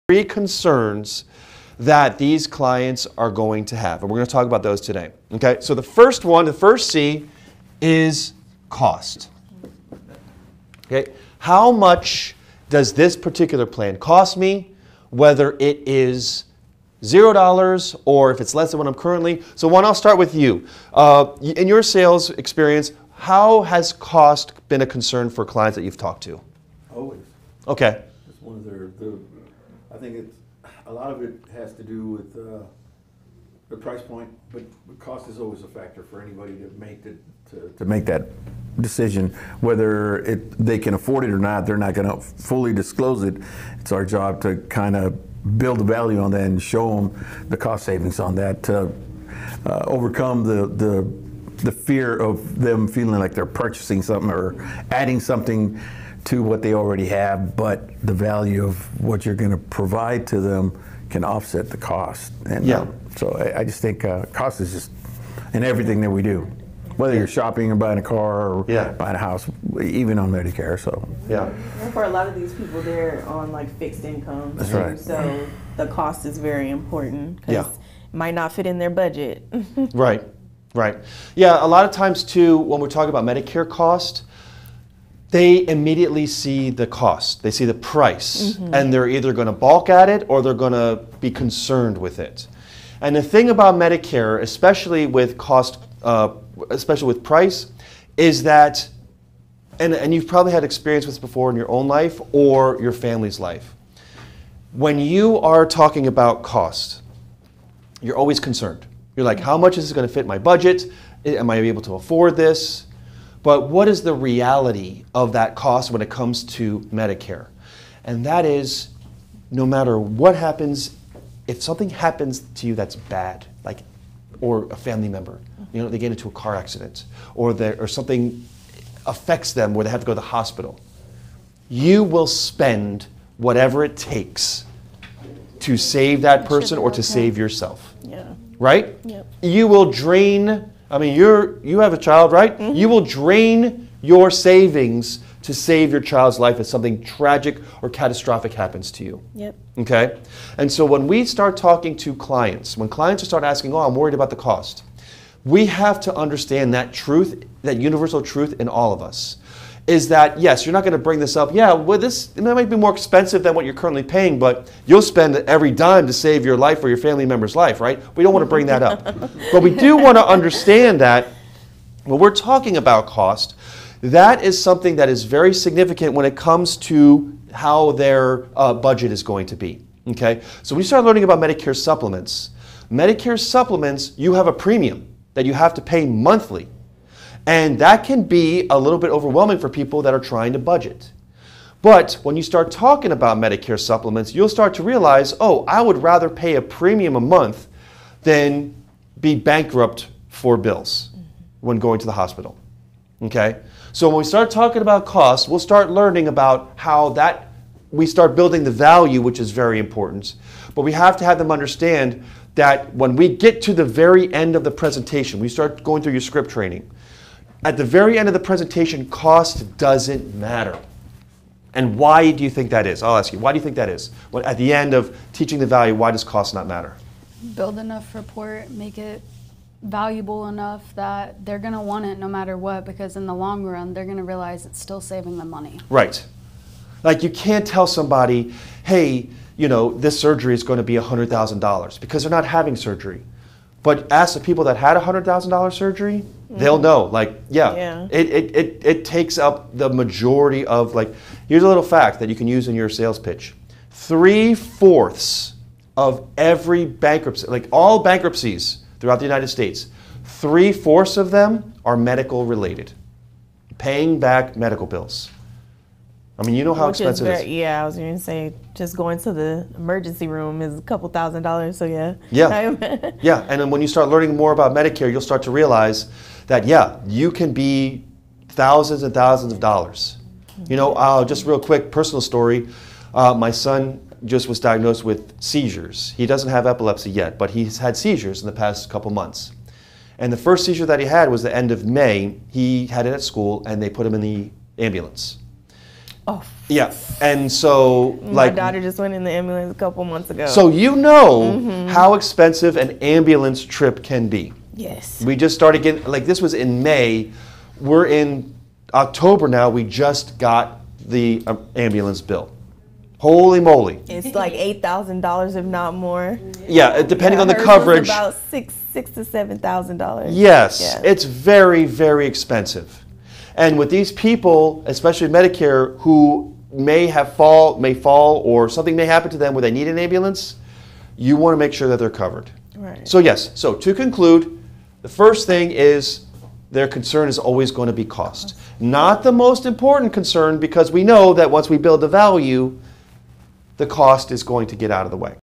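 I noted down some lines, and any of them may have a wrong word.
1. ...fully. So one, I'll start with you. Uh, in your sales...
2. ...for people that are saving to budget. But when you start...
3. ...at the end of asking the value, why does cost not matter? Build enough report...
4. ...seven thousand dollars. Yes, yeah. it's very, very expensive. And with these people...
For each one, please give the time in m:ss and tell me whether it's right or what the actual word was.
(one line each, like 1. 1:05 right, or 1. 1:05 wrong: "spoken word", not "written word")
1. 0:18 wrong: "currently", not "fully"
2. 3:09 wrong: "trying", not "saving"
3. 3:44 wrong: "teaching", not "asking"
4. 5:19 right.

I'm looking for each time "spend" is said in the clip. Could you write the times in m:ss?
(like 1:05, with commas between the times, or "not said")
2:12, 2:45.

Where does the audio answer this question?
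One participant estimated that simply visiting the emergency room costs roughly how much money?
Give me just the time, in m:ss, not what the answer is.
4:30.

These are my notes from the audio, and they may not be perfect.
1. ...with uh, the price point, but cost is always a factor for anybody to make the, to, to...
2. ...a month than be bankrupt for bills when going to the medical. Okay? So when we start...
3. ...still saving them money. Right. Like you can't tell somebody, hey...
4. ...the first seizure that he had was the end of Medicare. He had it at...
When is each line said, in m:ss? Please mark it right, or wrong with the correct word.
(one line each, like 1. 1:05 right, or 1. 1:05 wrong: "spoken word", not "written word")
1. 0:32 right
2. 3:17 wrong: "hospital", not "medical"
3. 3:54 right
4. 4:50 wrong: "May", not "Medicare".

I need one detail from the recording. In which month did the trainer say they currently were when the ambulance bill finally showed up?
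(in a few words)
October.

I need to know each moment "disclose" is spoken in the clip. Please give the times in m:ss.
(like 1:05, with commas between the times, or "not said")
0:42.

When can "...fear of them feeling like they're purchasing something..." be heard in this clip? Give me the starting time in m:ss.
0:51.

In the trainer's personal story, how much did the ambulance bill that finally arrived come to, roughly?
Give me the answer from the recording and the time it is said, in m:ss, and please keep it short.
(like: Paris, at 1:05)
$8,000, at 5:14.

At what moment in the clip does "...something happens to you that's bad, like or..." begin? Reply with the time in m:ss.
2:01.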